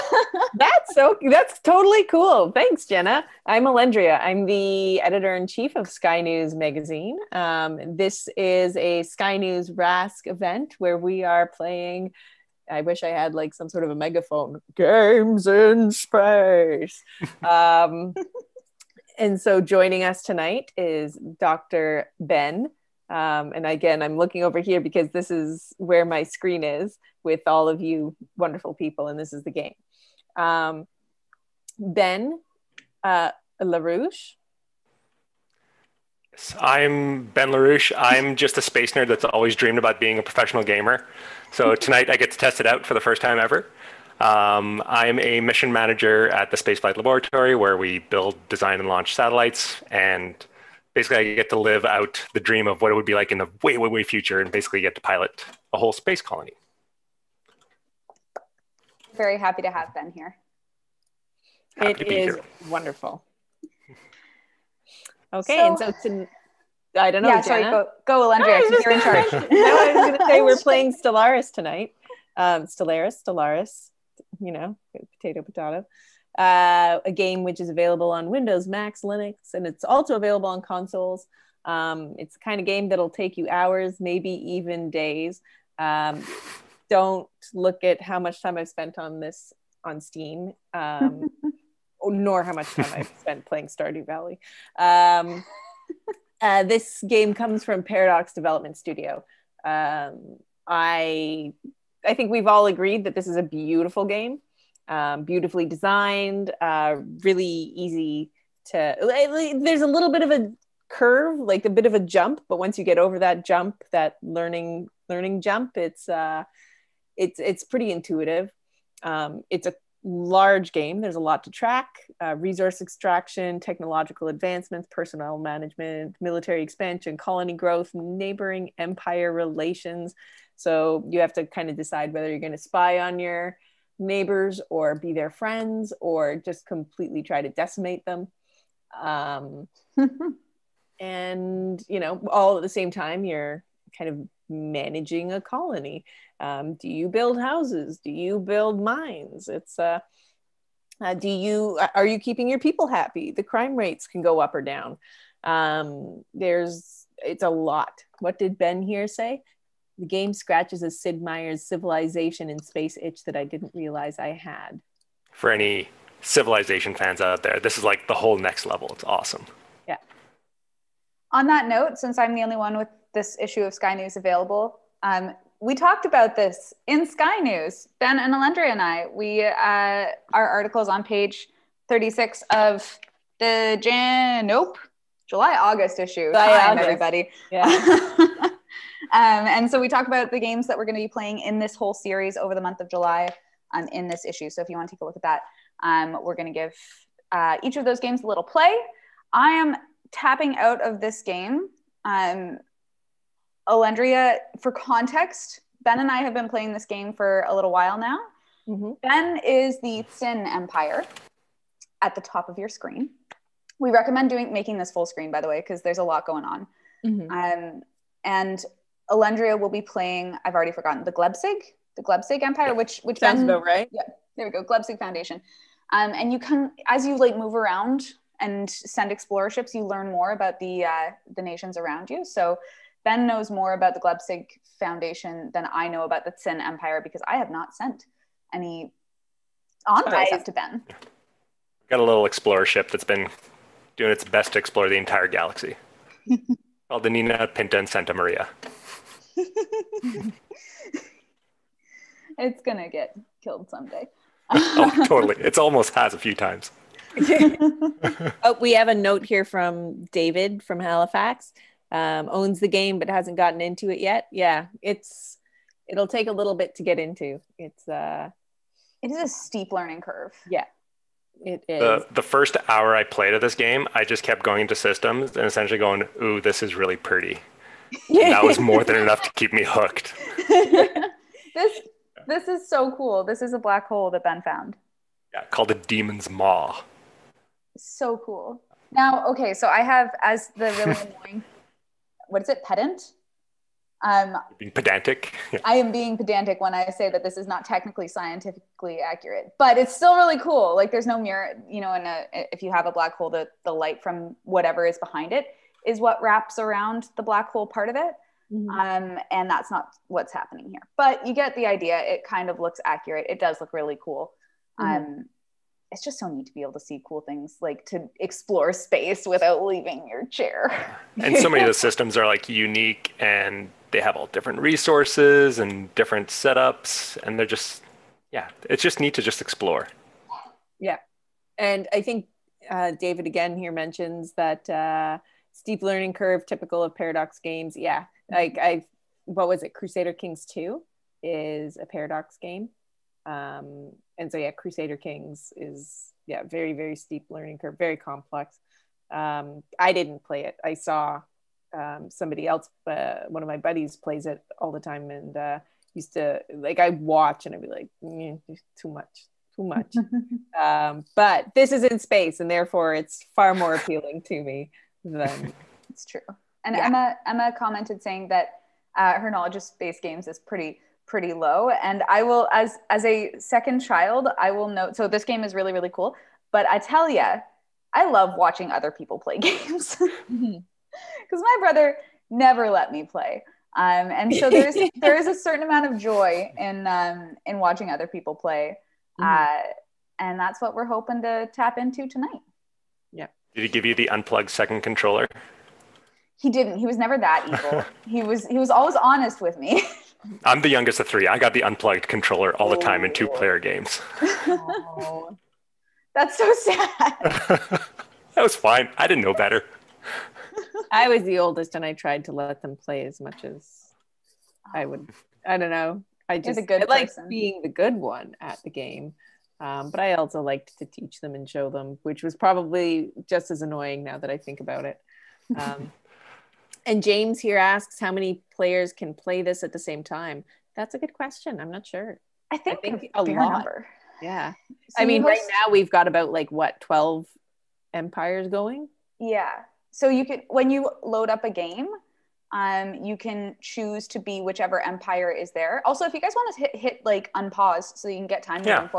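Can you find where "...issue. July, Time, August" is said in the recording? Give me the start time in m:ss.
3:05.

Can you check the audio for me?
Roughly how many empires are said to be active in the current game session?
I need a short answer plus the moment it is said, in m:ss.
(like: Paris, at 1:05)
12, at 7:16.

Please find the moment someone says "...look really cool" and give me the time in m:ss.
5:13.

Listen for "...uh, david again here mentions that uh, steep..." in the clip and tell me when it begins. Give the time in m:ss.
5:32.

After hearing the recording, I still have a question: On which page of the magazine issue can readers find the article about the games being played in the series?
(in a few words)
36.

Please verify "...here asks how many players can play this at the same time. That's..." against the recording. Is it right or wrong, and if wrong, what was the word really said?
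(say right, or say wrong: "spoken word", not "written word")
right.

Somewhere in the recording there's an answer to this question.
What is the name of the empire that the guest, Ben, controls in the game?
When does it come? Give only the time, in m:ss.
3:30.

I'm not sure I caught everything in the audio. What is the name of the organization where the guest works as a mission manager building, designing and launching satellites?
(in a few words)
Spaceflight Laboratory.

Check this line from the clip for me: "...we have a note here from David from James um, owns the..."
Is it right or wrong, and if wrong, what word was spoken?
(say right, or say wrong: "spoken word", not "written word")
wrong: "Halifax", not "James".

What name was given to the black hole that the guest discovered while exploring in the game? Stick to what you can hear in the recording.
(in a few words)
Demon's Maw.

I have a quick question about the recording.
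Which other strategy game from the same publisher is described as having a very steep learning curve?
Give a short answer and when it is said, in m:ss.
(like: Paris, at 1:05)
Crusader Kings 2, at 5:39.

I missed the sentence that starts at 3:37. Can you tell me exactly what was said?
Um, and Alendria will be playing.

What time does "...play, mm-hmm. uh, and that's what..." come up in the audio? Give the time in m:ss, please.
6:28.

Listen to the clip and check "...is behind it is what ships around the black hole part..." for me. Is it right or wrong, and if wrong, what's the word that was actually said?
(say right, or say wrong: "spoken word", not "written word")
wrong: "wraps", not "ships".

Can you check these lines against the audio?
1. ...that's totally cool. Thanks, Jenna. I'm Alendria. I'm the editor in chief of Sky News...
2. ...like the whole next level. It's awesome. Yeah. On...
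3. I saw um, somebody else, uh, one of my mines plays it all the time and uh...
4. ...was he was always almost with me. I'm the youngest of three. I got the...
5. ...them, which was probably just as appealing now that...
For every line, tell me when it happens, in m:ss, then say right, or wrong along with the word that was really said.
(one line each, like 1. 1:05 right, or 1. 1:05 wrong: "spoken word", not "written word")
1. 0:01 right
2. 2:47 right
3. 5:50 wrong: "buddies", not "mines"
4. 6:38 wrong: "honest", not "almost"
5. 7:01 wrong: "annoying", not "appealing".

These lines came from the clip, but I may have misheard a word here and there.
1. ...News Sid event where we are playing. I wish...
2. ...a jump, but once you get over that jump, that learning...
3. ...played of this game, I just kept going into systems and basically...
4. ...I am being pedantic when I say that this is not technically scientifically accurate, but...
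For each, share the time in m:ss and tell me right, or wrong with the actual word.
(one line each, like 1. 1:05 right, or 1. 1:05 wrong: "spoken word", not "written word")
1. 0:09 wrong: "RASC", not "Sid"
2. 1:51 right
3. 4:33 wrong: "essentially", not "basically"
4. 4:55 right.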